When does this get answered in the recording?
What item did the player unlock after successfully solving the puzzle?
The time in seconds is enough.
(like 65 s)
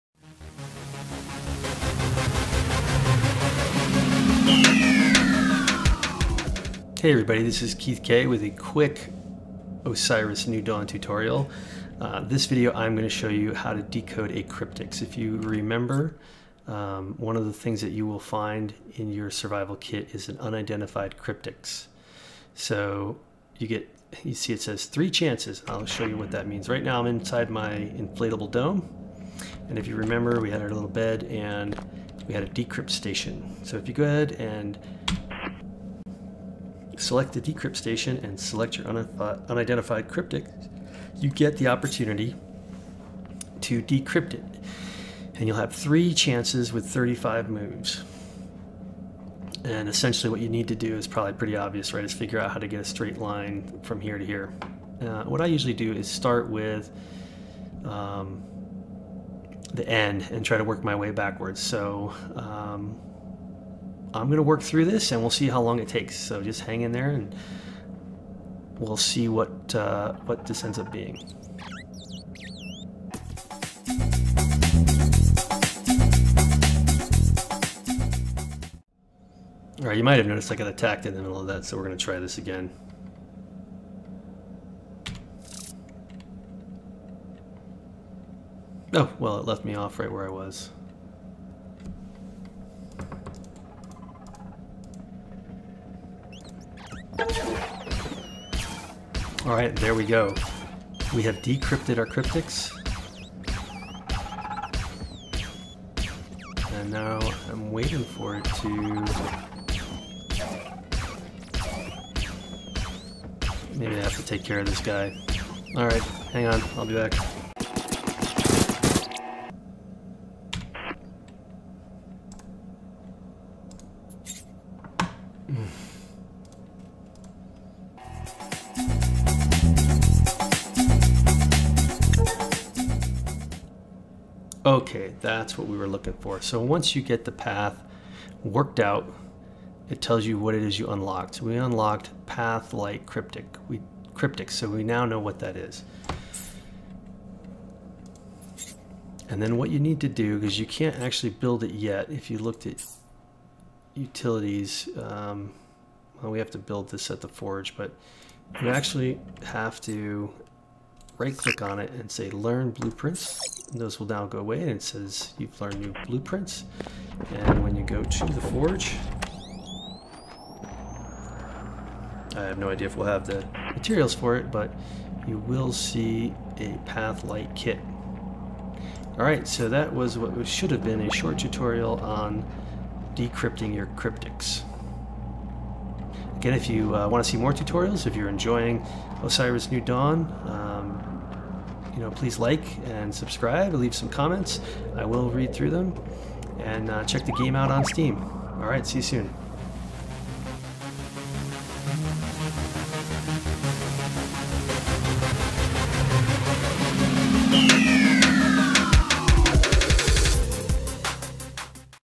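176 s.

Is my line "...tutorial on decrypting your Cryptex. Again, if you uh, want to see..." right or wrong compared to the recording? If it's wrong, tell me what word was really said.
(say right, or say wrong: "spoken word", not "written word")
right.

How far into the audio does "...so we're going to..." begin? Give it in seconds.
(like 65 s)
81 s.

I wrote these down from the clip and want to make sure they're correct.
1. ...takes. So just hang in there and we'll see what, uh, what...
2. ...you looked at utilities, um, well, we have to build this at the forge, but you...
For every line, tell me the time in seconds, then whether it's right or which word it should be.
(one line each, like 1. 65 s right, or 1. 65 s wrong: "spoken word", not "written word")
1. 65 s right
2. 152 s right.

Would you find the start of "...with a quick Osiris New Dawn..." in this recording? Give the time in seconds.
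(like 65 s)
8 s.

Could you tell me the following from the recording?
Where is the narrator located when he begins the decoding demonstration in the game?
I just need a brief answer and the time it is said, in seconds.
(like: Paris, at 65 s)
inflatable dome, at 27 s.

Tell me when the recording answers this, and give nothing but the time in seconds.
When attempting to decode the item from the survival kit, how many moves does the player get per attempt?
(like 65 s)
46 s.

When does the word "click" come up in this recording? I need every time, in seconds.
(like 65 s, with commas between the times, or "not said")
161 s.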